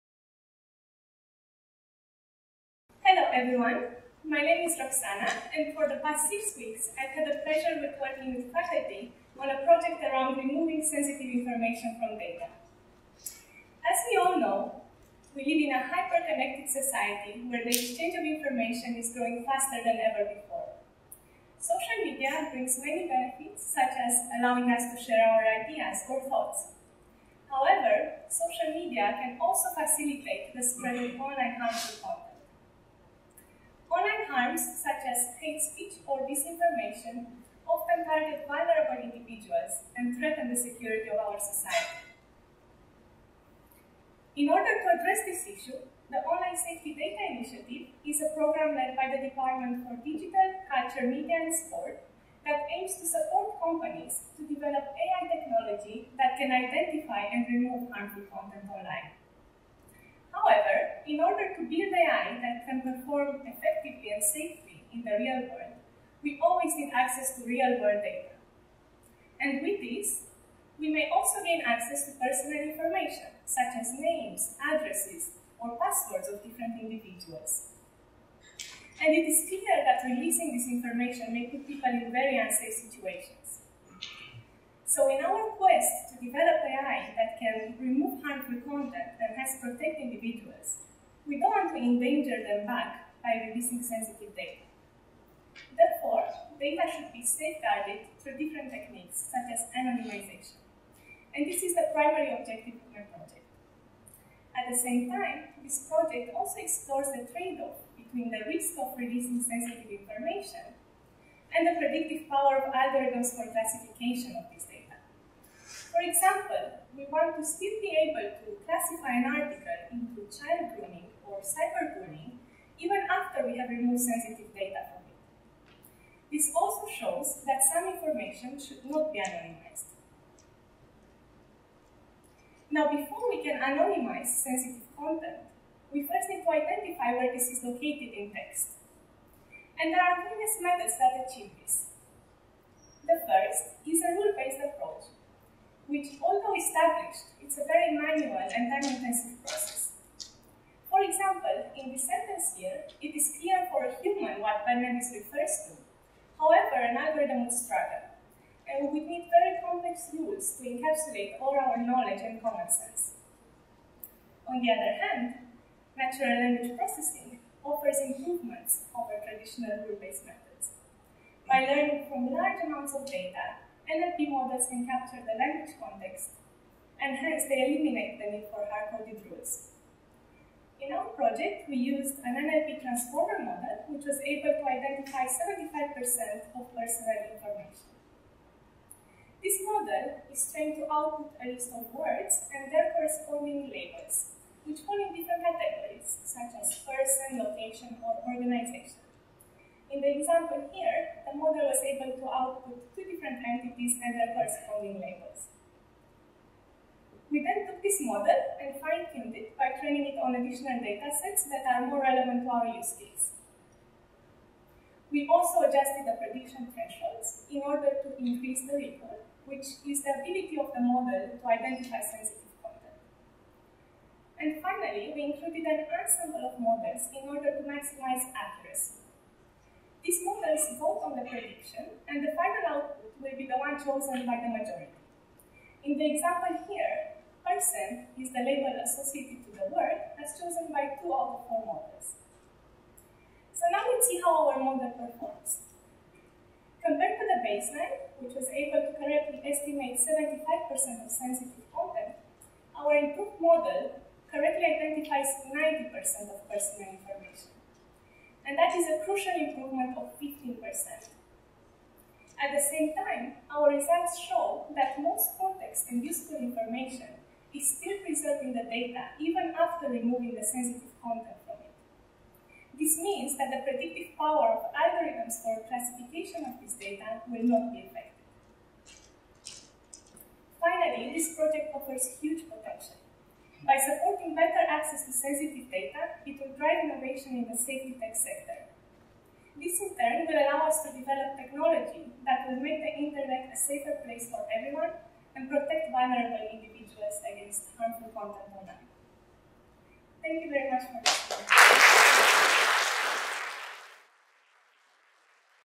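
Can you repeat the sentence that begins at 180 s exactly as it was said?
In our project, we used an NLP transformer model, which was able identify 75% of personal information.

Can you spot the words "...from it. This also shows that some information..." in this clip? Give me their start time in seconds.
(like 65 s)
124 s.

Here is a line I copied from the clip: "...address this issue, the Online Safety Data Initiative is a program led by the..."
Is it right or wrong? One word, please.
right.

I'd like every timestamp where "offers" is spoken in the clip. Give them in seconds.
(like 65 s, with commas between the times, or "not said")
167 s, 281 s.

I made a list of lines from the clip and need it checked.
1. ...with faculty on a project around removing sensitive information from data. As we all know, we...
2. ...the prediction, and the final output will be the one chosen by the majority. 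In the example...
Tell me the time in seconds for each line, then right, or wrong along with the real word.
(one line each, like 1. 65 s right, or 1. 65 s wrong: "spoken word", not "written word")
1. 8 s right
2. 231 s right.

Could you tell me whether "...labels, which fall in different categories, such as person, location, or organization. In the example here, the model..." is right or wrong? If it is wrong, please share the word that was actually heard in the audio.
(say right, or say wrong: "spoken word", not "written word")
right.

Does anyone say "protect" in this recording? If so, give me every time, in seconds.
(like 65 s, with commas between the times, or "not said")
89 s, 295 s.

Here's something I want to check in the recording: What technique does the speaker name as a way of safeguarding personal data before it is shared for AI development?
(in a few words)
anonymization.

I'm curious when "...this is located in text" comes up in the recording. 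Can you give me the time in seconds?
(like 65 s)
137 s.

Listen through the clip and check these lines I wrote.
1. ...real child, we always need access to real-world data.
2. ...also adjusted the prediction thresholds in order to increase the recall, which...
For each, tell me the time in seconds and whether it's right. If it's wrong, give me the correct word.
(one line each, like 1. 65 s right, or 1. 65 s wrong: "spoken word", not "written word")
1. 65 s wrong: "world", not "child"
2. 215 s right.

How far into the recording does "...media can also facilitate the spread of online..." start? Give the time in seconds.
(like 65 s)
28 s.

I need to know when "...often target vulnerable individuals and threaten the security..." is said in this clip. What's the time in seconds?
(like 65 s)
37 s.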